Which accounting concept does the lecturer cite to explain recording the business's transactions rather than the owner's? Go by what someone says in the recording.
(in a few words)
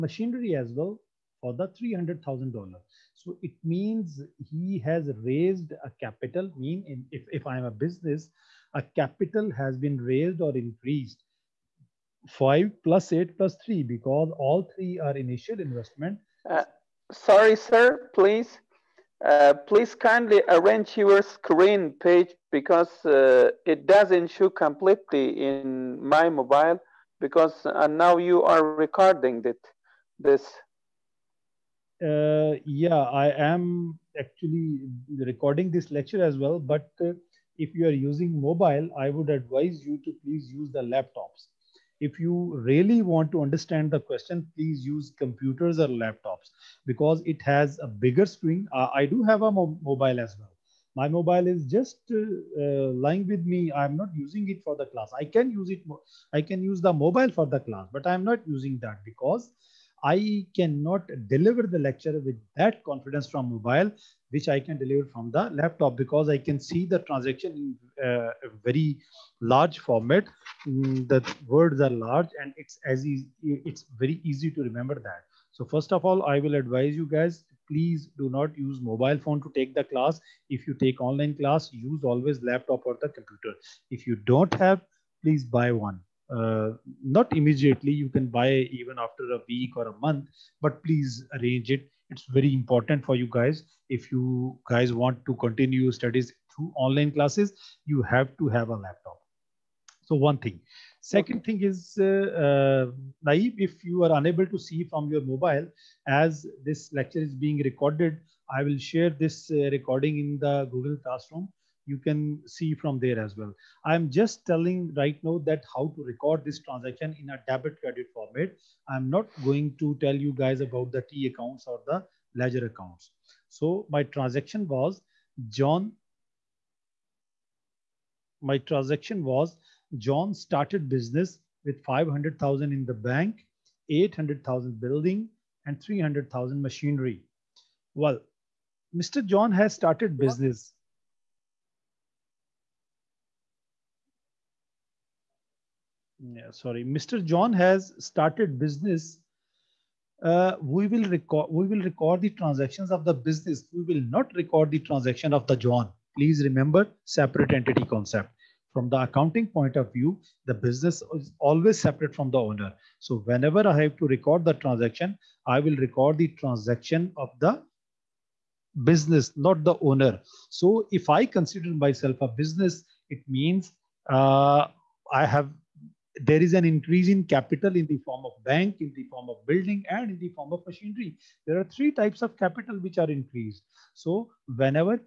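Separate entity concept.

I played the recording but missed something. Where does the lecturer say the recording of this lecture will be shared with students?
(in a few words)
Google Classroom.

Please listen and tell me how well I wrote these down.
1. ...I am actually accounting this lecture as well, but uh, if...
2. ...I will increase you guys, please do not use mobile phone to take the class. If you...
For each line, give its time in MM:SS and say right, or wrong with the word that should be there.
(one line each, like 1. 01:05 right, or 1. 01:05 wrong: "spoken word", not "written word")
1. 00:33 wrong: "recording", not "accounting"
2. 01:16 wrong: "advise", not "increase".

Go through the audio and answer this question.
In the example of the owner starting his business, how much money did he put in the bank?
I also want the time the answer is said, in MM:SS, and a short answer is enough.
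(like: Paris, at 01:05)
500,000, at 02:11.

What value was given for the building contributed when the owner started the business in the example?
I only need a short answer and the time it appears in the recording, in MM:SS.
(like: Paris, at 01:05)
800,000, at 02:13.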